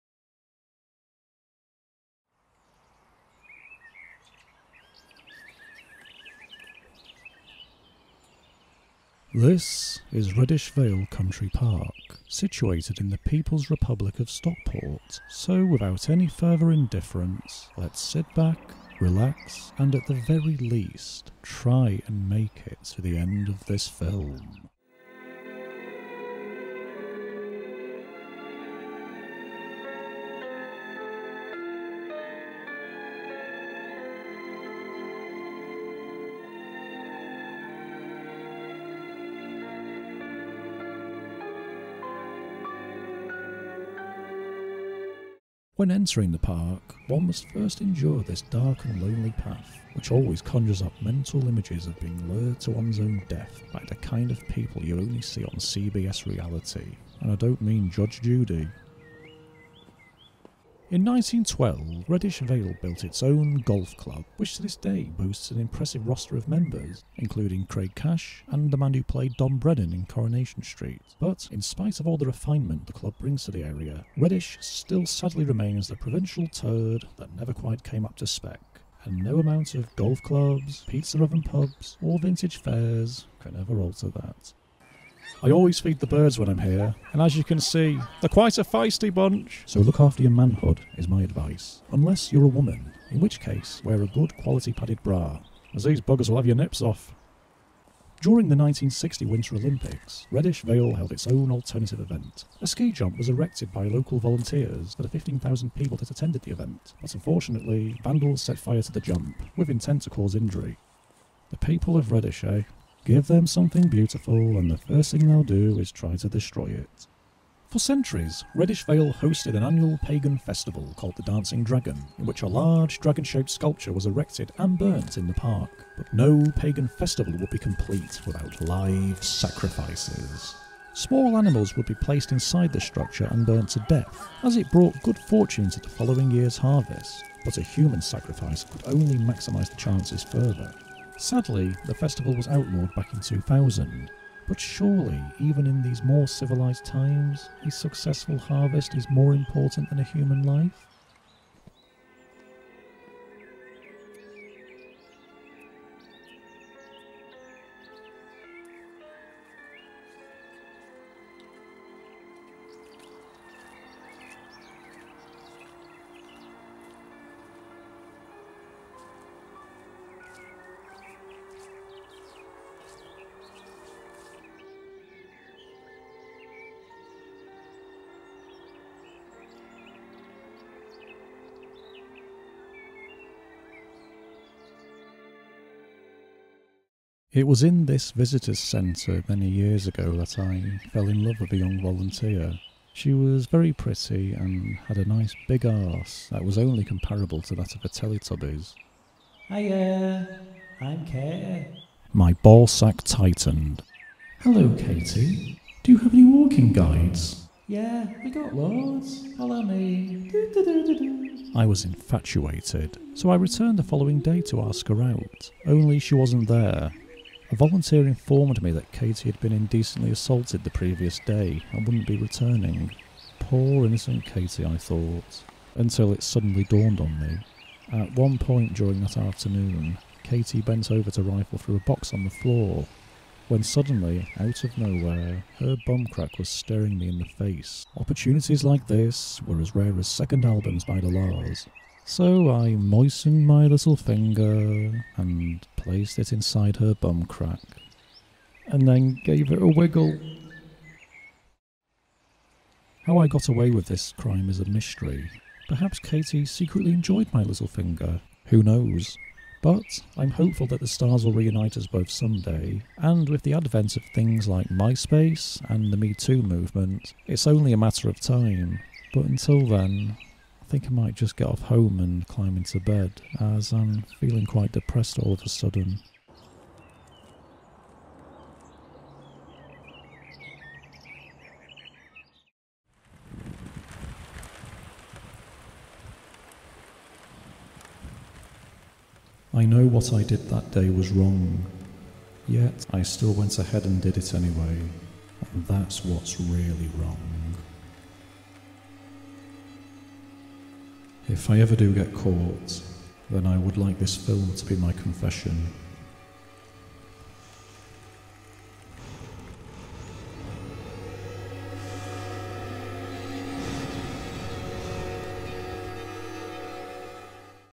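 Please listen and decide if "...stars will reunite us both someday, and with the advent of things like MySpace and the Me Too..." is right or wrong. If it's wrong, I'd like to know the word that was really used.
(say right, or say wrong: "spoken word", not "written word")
right.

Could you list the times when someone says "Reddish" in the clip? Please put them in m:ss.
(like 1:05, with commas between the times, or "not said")
0:10, 1:02, 1:14, 1:40, 1:52, 1:58.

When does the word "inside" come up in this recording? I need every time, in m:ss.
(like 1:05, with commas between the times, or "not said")
2:12, 4:06.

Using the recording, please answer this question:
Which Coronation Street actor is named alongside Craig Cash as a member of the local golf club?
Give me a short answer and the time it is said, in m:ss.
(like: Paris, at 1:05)
Don Brennan, at 1:09.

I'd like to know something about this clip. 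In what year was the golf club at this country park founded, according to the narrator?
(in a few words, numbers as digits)
1912.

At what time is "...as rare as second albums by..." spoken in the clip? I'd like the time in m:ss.
3:59.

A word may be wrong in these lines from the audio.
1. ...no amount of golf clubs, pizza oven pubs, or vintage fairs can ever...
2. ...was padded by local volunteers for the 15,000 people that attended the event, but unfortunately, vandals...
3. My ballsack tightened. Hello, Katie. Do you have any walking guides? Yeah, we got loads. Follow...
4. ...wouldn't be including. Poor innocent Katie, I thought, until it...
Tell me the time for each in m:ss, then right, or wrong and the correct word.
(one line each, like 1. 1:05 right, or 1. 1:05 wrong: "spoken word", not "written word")
1. 1:19 right
2. 1:43 wrong: "erected", not "padded"
3. 3:22 right
4. 3:41 wrong: "returning", not "including".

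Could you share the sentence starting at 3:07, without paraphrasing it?
It was in this visitors centre many years ago that I fell in love with a young volunteer.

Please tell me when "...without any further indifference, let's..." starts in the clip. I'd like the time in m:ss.
0:15.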